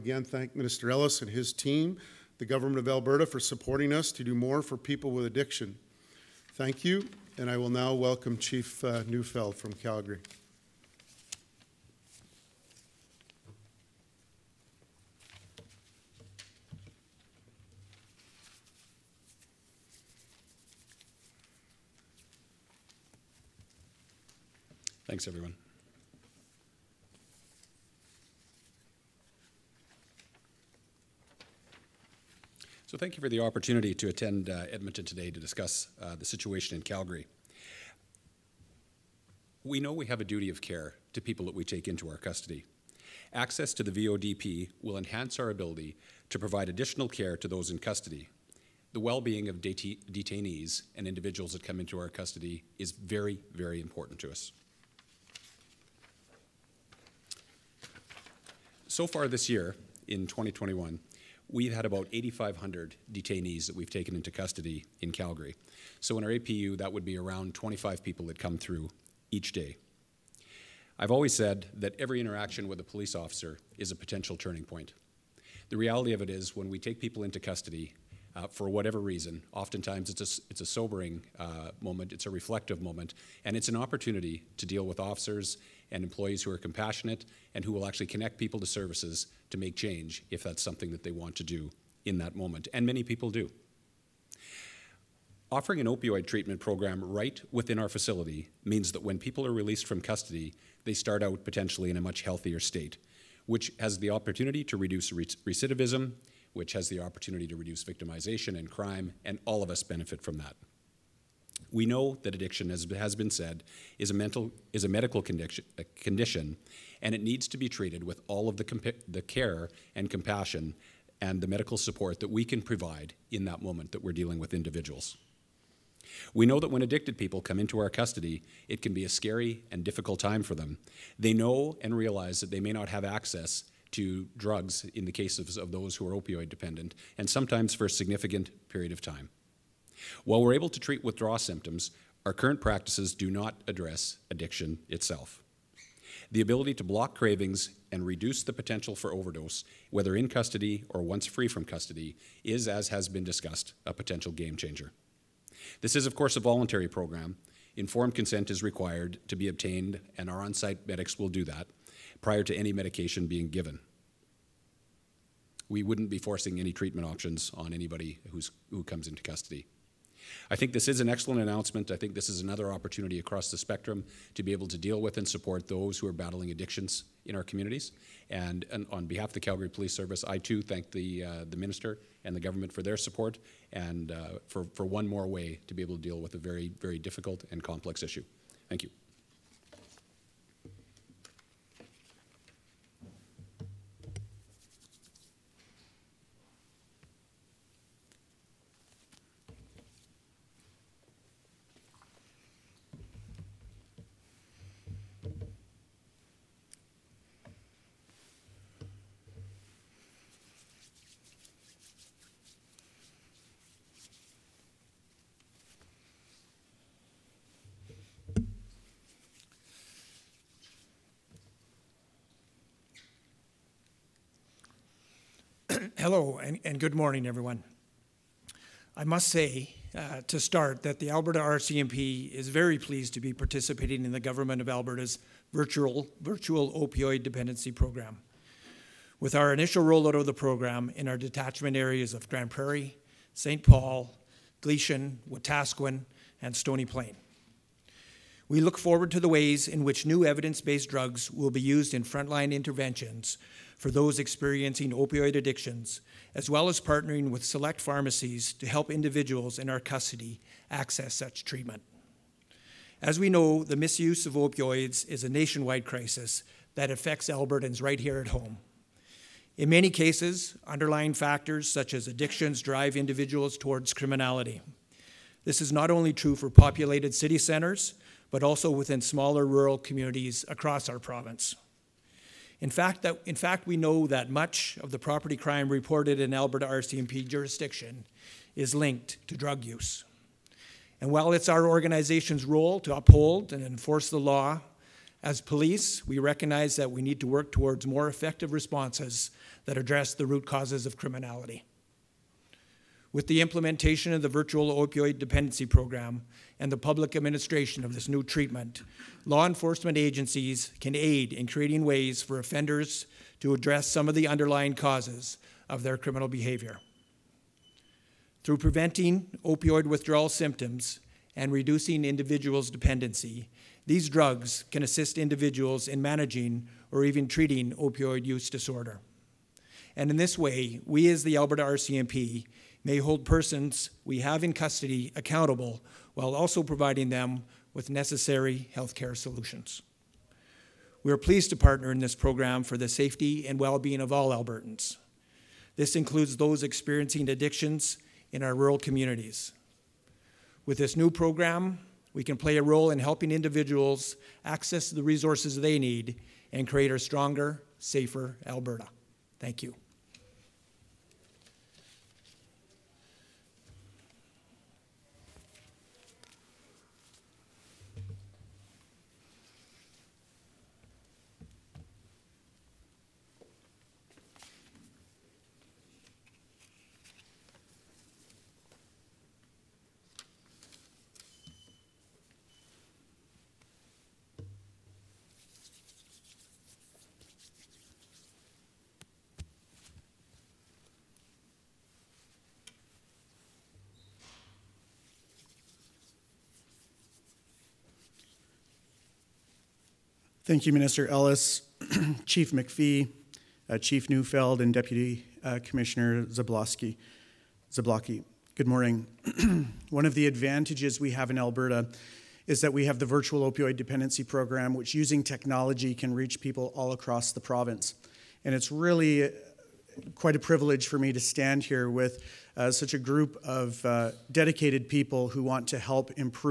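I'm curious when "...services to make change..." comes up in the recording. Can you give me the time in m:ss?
1:28.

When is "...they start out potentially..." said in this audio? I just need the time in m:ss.
1:40.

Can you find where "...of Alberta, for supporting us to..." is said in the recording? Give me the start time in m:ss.
0:02.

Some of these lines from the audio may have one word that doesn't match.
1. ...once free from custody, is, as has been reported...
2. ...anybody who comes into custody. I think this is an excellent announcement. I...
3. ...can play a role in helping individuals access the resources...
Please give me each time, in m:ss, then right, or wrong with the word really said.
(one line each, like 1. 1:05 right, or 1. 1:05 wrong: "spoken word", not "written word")
1. 2:31 wrong: "discussed", not "reported"
2. 2:47 right
3. 5:52 right.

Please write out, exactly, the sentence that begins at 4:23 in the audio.
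As we know, the misuse of opioids is a nationwide crisis that affects Albertans right here at home.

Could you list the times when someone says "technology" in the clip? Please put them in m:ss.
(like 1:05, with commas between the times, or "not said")
6:55.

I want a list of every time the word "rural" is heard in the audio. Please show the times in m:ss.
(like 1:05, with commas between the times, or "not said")
4:39, 5:48.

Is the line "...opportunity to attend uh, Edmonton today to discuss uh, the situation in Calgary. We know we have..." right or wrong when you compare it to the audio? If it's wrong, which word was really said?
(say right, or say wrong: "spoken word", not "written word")
right.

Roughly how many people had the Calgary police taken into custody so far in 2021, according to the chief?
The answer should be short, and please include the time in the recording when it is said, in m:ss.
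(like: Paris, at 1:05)
8,500, at 1:02.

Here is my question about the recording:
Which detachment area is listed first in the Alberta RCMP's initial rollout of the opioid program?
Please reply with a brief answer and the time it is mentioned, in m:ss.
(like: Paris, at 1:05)
Grande Prairie, at 4:02.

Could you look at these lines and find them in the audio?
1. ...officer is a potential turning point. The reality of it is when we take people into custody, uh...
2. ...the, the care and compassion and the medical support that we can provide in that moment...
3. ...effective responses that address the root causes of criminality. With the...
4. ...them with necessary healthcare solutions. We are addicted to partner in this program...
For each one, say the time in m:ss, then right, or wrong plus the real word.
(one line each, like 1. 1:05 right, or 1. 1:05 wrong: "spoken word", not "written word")
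1. 1:13 right
2. 1:58 right
3. 4:58 right
4. 5:37 wrong: "pleased", not "addicted".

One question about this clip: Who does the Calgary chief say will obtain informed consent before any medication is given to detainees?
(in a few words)
on site medics.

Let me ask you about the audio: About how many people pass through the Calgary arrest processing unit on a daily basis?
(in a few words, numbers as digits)
25.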